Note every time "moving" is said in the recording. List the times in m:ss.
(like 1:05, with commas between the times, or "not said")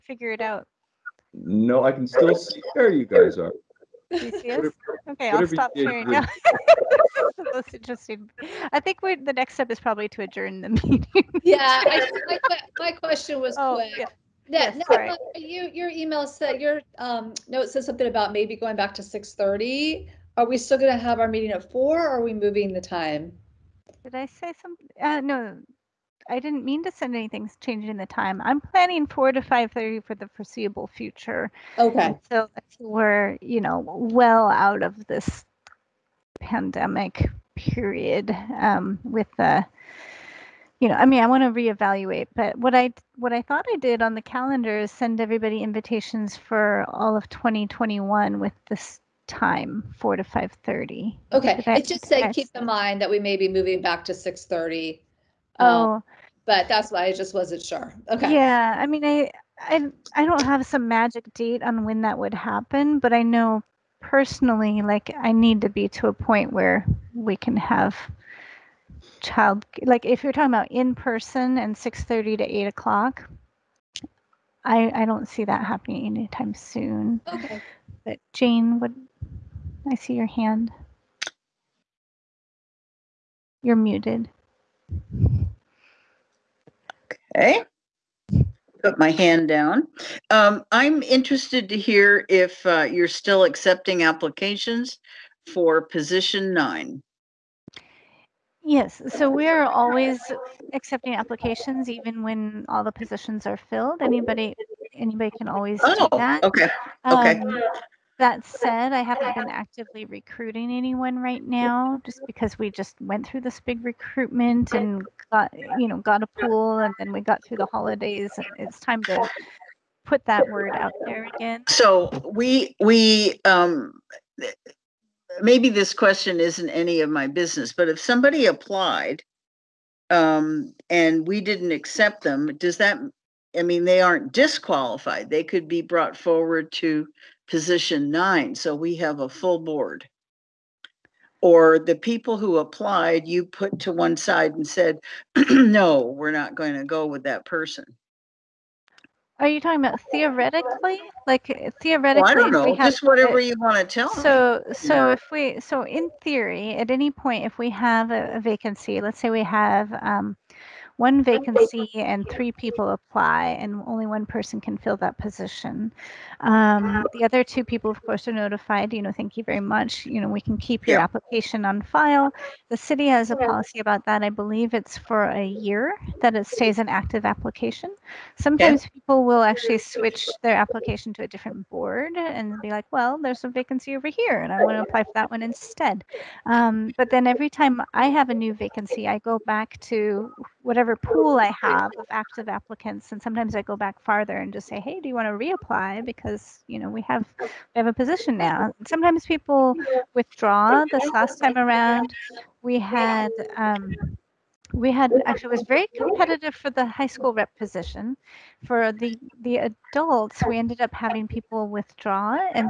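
0:22, 0:53.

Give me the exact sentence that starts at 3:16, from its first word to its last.
Because, you know, we have we have a position now.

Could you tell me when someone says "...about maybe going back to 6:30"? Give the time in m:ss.
0:18.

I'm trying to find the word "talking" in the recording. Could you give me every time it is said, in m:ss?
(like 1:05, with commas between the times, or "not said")
1:10, 2:29.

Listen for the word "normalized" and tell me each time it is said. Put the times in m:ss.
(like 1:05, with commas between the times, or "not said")
not said.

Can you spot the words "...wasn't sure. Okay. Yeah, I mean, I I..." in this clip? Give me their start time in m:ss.
0:57.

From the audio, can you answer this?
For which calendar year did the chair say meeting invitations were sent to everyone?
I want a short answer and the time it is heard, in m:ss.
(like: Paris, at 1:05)
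2021, at 0:47.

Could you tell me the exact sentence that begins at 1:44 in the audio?
Anybody, anybody can always do oh, that.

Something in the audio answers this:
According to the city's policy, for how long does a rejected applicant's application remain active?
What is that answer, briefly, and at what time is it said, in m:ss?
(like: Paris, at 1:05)
a year, at 2:55.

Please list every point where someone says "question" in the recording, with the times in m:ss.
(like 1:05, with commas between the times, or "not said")
0:12, 2:05.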